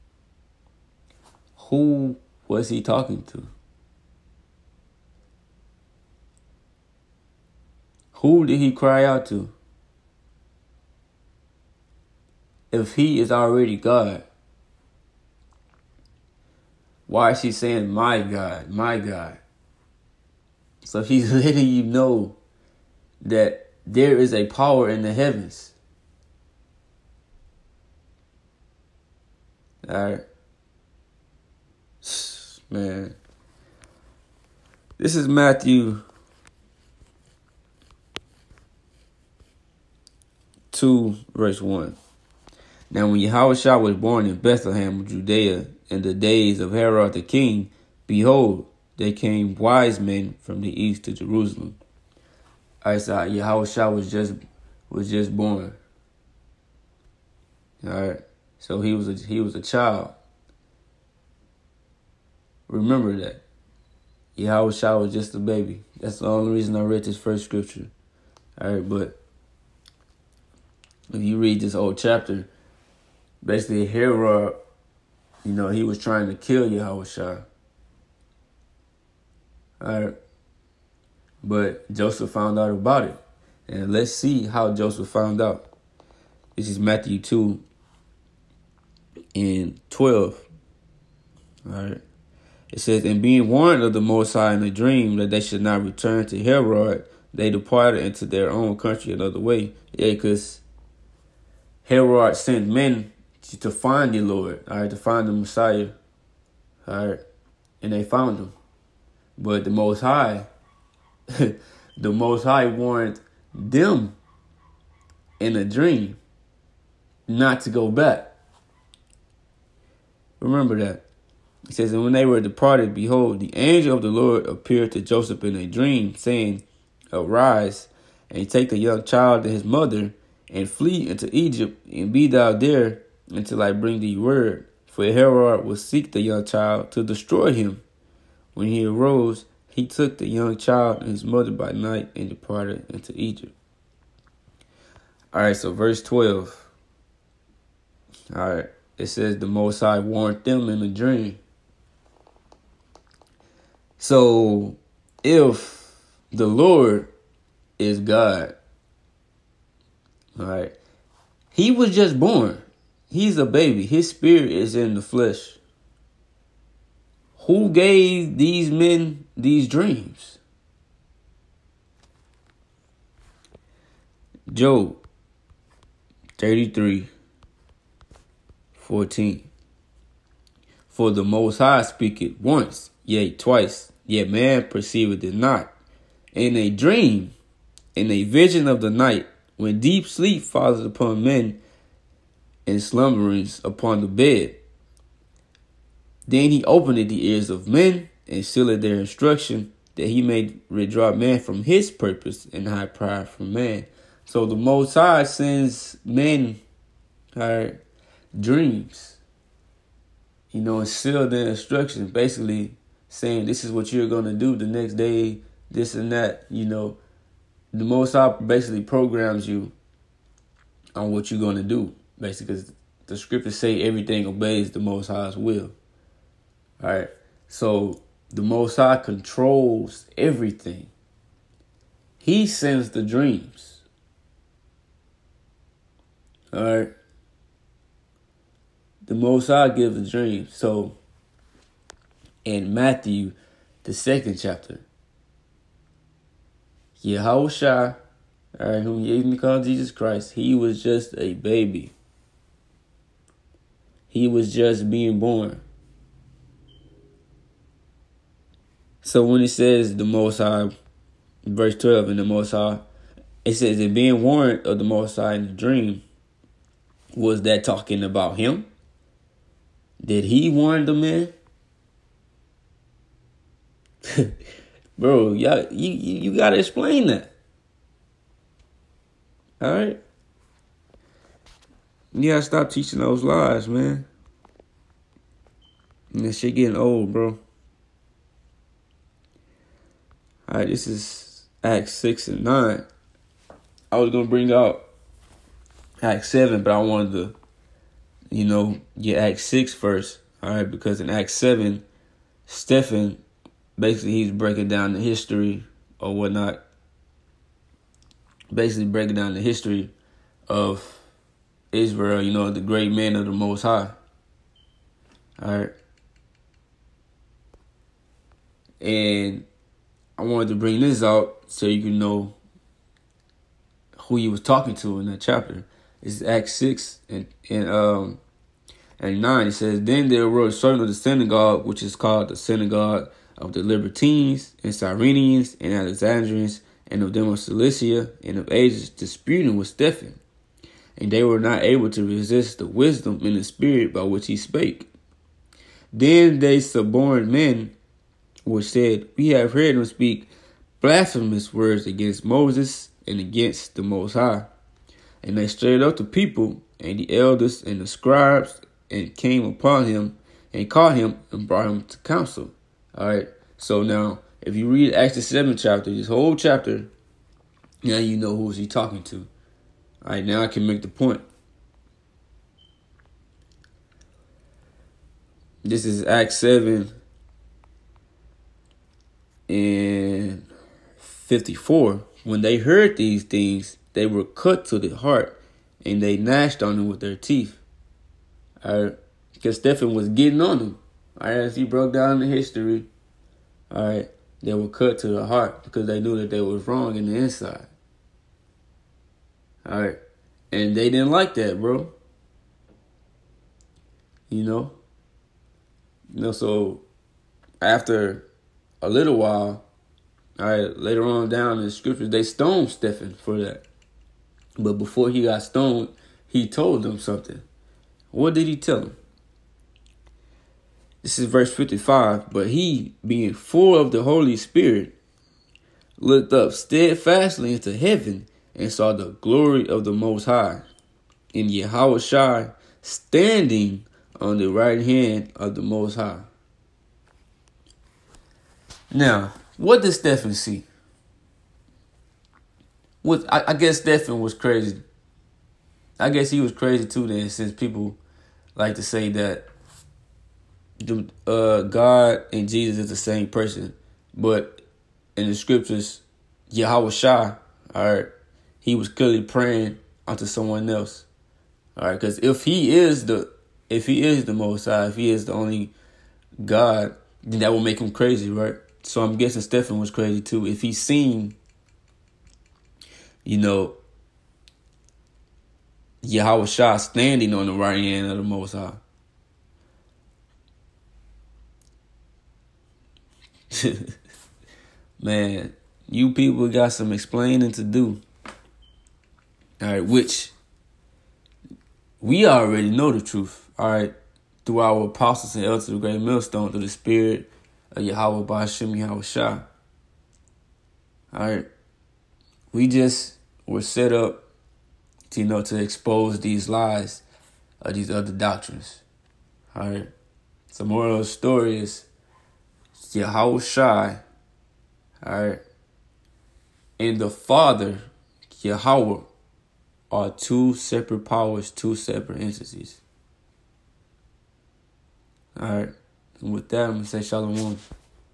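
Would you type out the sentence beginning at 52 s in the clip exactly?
I saw Yahushua was just was just born.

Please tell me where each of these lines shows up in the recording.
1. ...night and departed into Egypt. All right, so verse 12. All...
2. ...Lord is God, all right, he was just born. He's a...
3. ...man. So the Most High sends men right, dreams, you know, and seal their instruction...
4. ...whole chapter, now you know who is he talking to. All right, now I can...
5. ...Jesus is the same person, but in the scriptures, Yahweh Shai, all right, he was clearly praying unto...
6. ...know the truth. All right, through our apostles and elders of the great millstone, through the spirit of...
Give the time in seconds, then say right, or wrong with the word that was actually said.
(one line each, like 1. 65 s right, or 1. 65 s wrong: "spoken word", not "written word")
1. 141 s right
2. 156 s right
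3. 203 s right
4. 366 s right
5. 452 s right
6. 492 s right.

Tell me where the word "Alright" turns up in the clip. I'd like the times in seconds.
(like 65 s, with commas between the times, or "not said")
79 s, 91 s, 290 s, 300 s.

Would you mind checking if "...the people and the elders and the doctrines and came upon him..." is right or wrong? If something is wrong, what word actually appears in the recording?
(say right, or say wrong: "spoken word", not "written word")
wrong: "scribes", not "doctrines".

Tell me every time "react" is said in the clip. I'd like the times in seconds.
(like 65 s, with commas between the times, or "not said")
not said.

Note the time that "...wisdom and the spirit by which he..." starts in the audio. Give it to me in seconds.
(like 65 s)
342 s.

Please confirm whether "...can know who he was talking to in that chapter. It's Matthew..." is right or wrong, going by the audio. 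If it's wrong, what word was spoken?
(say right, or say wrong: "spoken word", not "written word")
wrong: "Acts", not "Matthew".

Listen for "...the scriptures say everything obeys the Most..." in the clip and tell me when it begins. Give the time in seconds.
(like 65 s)
223 s.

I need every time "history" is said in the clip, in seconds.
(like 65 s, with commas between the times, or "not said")
304 s, 309 s, 392 s.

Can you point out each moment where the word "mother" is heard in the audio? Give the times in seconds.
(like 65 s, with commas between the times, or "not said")
129 s, 141 s.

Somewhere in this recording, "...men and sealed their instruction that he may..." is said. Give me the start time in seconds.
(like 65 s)
197 s.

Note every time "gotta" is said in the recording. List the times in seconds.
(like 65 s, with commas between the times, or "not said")
276 s, 282 s.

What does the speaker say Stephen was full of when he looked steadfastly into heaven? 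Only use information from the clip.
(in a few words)
the Holy Spirit.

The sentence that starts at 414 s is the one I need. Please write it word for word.
But before he got stoned, he told them something.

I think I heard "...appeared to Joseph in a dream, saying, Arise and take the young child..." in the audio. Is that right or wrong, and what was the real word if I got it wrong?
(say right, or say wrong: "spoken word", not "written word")
right.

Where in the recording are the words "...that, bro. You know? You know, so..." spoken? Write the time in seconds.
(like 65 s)
401 s.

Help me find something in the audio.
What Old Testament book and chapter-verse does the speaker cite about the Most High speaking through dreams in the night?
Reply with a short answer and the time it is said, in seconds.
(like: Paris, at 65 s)
Job 33:14, at 174 s.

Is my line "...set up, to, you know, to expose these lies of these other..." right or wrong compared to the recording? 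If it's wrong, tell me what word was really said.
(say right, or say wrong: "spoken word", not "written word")
right.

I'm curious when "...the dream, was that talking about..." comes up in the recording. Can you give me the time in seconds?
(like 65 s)
265 s.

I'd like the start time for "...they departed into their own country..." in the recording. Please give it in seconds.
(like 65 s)
97 s.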